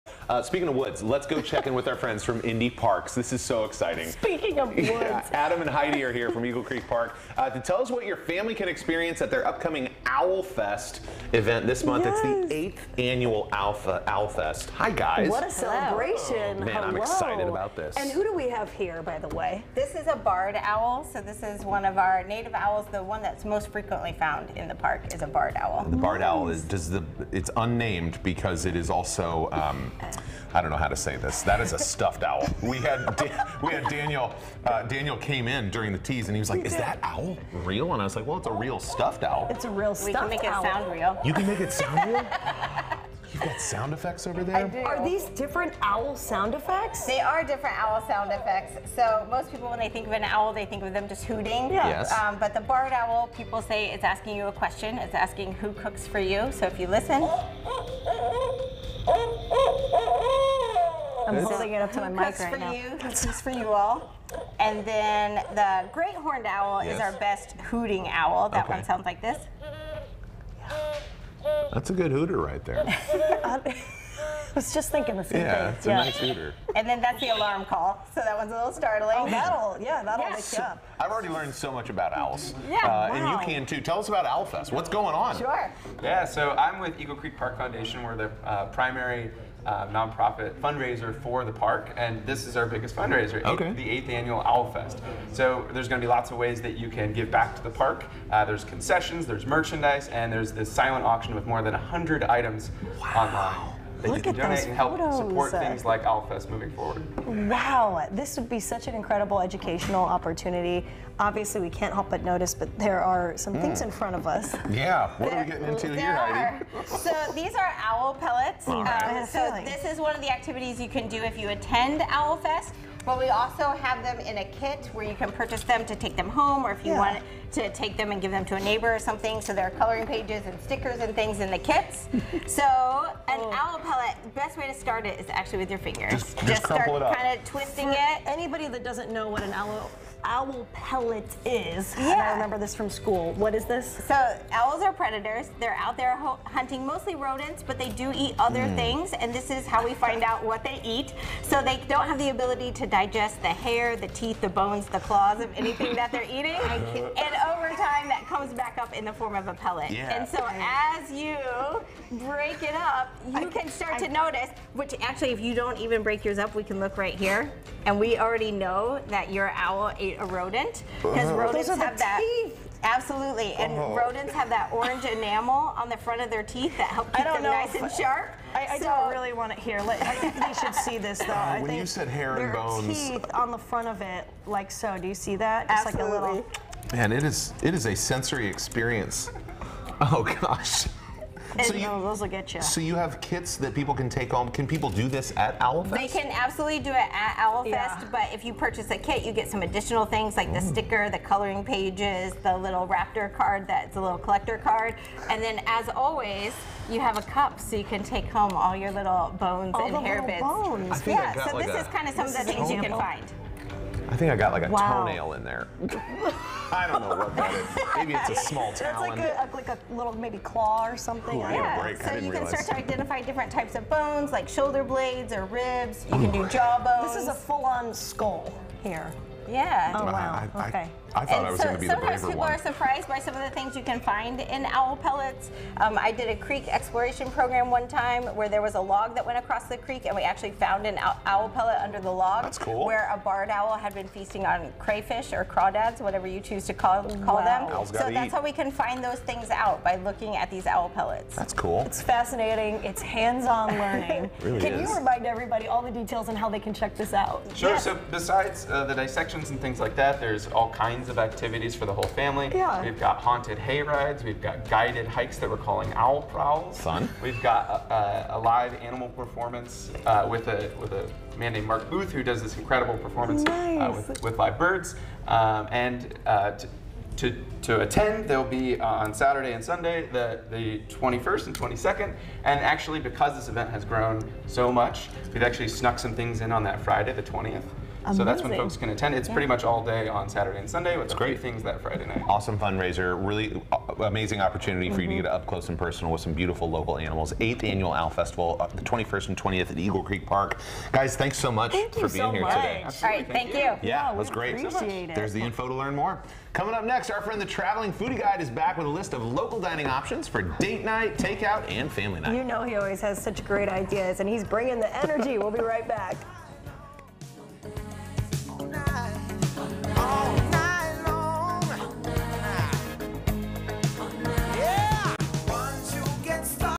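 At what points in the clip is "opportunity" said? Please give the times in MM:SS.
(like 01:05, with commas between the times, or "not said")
01:50, 04:54.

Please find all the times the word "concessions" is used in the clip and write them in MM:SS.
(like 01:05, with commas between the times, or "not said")
01:38.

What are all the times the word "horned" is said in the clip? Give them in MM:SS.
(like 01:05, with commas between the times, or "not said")
01:06.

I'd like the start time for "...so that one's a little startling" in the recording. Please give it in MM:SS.
01:18.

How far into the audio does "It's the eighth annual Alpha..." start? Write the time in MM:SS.
00:12.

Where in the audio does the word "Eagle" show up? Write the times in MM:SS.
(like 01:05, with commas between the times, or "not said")
00:06, 01:26, 04:59.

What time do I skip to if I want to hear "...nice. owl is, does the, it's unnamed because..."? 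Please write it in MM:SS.
00:26.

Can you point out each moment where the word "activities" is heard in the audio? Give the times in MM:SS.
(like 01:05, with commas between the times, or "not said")
02:00, 04:21.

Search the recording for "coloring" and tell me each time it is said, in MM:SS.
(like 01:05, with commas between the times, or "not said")
02:09, 03:21.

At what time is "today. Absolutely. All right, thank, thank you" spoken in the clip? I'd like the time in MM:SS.
05:02.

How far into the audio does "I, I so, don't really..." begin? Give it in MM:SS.
02:58.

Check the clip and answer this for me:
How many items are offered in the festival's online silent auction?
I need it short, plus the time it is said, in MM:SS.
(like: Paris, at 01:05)
More than 100, at 01:41.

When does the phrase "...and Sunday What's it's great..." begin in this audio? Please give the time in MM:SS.
04:50.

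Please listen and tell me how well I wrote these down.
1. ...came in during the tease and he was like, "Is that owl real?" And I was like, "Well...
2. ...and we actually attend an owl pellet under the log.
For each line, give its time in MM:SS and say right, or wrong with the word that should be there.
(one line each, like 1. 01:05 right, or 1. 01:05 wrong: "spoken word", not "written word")
1. 00:35 right
2. 04:00 wrong: "found", not "attend".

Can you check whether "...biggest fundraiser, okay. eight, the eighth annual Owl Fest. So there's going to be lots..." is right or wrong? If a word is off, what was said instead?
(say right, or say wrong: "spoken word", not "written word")
right.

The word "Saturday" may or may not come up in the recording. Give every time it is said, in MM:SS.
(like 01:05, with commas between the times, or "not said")
04:39, 04:50.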